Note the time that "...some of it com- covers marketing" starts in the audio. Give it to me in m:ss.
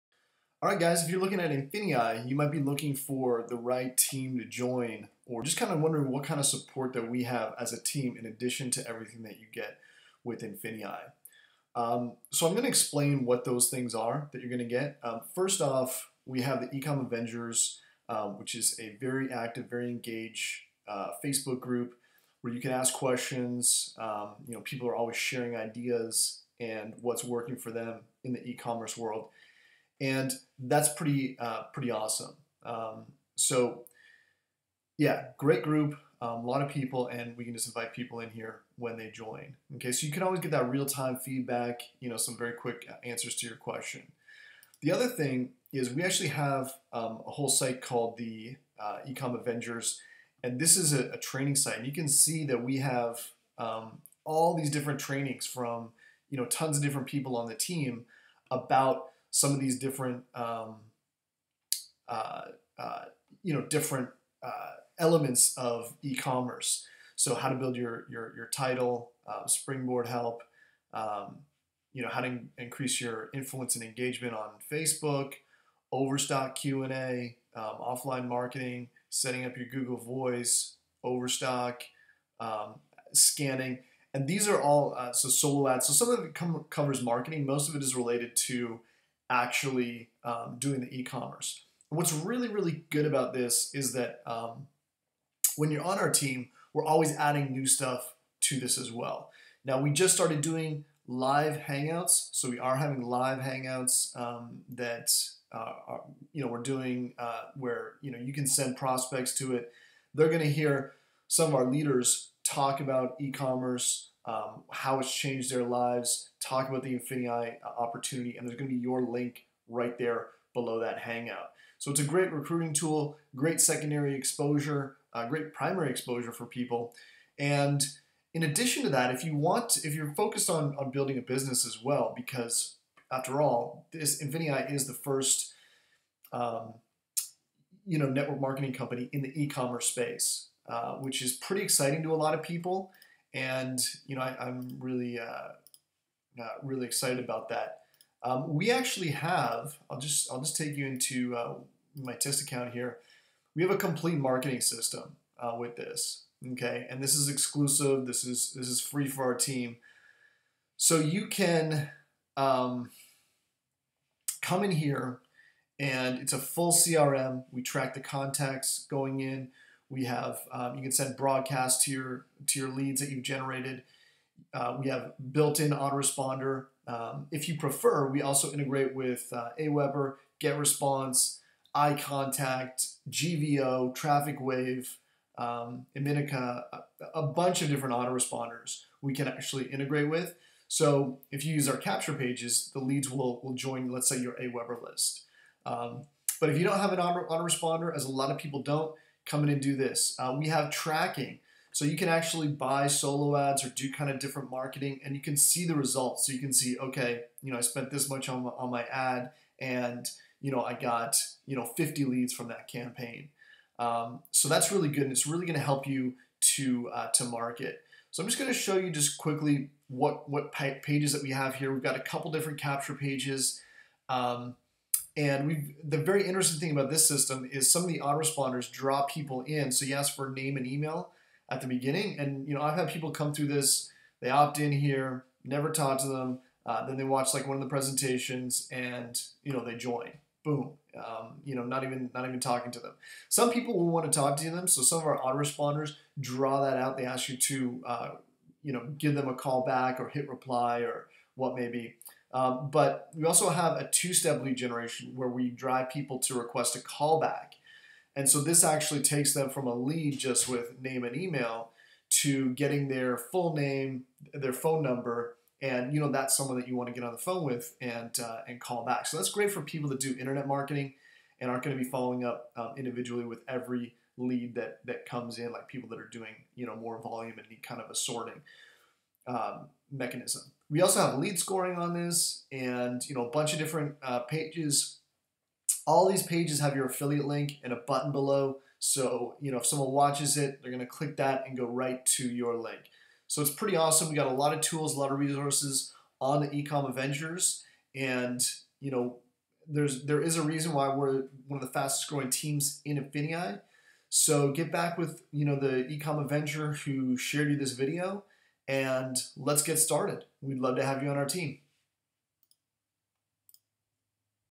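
1:25.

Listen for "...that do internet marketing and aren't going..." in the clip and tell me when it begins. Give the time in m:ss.
4:29.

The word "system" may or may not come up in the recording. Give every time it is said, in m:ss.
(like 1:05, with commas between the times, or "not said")
2:34, 3:47.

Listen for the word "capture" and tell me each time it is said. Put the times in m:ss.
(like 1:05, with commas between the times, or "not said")
3:11, 3:42.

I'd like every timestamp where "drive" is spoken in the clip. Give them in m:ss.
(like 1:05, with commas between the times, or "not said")
4:15.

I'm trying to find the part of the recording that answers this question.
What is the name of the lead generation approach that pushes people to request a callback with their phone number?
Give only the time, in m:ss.
4:13.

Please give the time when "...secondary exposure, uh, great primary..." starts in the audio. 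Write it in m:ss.
2:03.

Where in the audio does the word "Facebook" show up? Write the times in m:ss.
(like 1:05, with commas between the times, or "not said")
0:21, 1:14.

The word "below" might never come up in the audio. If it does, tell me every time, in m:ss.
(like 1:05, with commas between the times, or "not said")
2:00, 4:48.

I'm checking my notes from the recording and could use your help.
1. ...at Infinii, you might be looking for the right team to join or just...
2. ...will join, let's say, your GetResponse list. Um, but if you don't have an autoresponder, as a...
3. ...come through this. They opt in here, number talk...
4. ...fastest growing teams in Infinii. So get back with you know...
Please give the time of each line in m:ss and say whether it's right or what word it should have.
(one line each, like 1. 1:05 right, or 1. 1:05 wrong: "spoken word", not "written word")
1. 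0:01 right
2. 3:13 wrong: "AWeber", not "GetResponse"
3. 3:53 wrong: "never", not "number"
4. 5:01 right.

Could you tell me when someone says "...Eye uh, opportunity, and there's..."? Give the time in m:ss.
1:57.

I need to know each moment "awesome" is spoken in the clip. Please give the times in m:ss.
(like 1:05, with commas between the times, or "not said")
0:31, 4:53.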